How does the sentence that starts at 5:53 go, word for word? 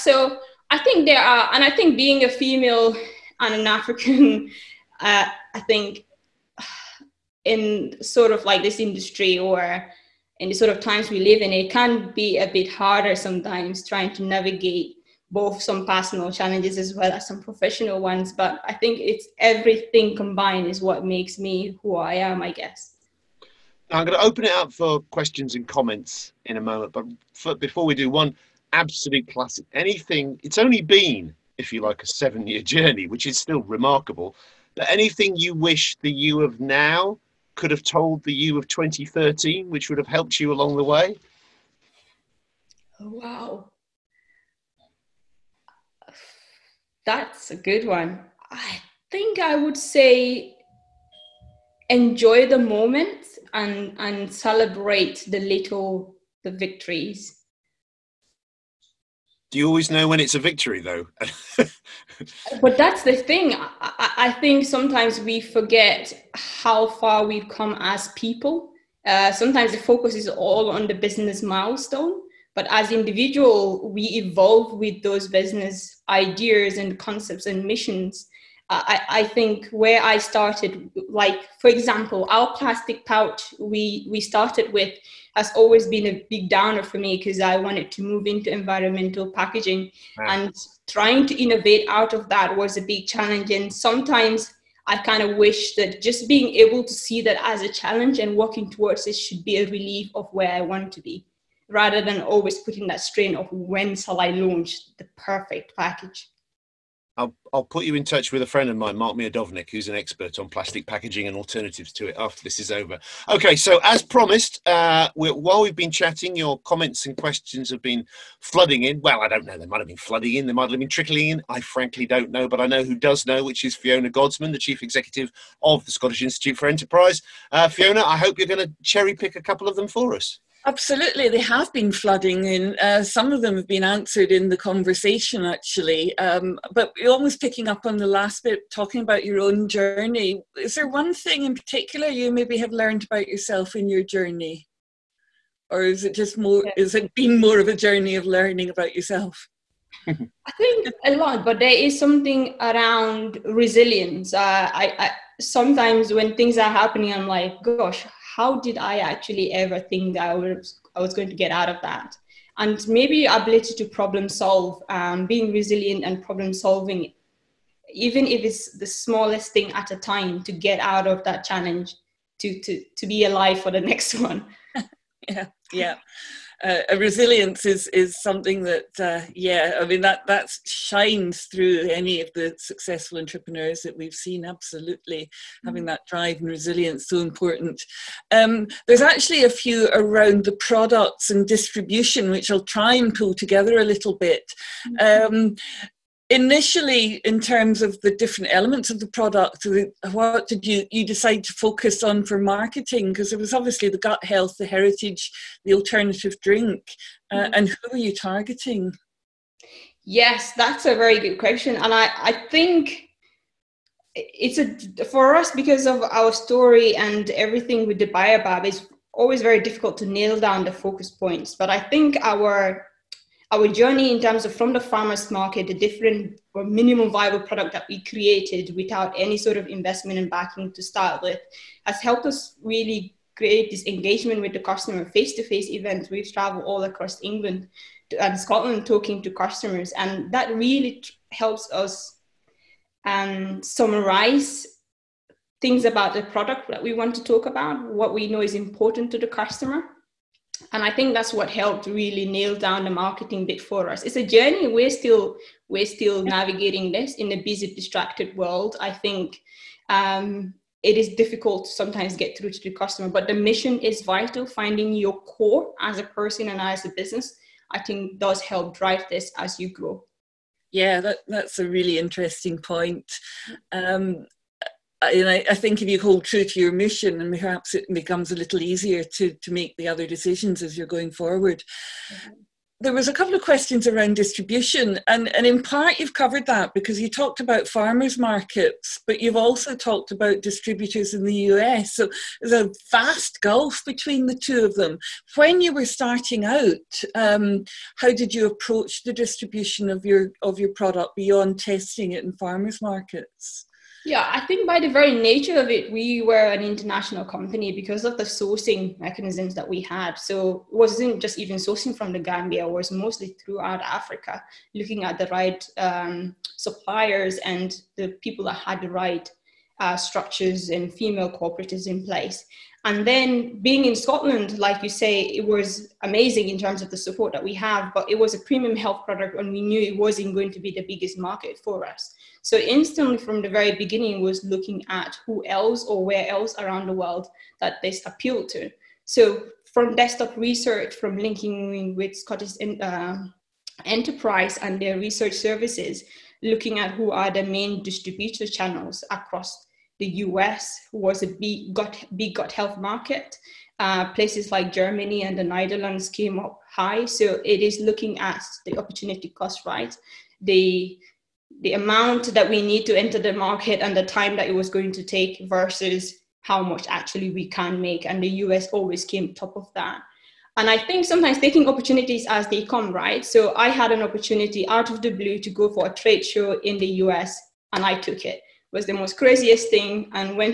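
Uh, places like Germany and the Netherlands came up high.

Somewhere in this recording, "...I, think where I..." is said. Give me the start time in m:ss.
1:19.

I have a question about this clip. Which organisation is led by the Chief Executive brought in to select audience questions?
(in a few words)
Scottish Institute for Enterprise.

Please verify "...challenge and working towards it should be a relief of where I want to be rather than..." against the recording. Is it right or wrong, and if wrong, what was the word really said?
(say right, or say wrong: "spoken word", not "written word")
right.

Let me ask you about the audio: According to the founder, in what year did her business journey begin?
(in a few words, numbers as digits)
2013.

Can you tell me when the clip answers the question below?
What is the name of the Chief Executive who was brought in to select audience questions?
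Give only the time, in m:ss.
2:03.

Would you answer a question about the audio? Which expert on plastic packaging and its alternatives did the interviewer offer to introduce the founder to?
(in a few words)
Mark Miodownik.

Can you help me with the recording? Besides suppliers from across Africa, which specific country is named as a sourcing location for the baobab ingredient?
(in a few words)
the Gambia.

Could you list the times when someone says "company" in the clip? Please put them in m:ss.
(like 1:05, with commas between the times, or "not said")
5:07.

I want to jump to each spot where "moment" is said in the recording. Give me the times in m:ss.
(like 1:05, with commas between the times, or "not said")
0:26, 0:52.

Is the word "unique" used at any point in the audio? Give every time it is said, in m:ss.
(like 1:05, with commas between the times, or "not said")
not said.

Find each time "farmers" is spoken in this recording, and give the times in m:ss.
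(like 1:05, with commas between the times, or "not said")
3:44, 4:47, 5:02.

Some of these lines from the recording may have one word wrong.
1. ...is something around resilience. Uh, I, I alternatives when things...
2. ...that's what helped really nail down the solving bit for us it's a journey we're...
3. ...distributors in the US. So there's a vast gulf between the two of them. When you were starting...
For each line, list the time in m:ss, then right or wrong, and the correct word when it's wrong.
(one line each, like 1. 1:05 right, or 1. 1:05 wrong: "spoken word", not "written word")
1. 2:31 wrong: "sometimes", not "alternatives"
2. 4:11 wrong: "marketing", not "solving"
3. 4:50 right.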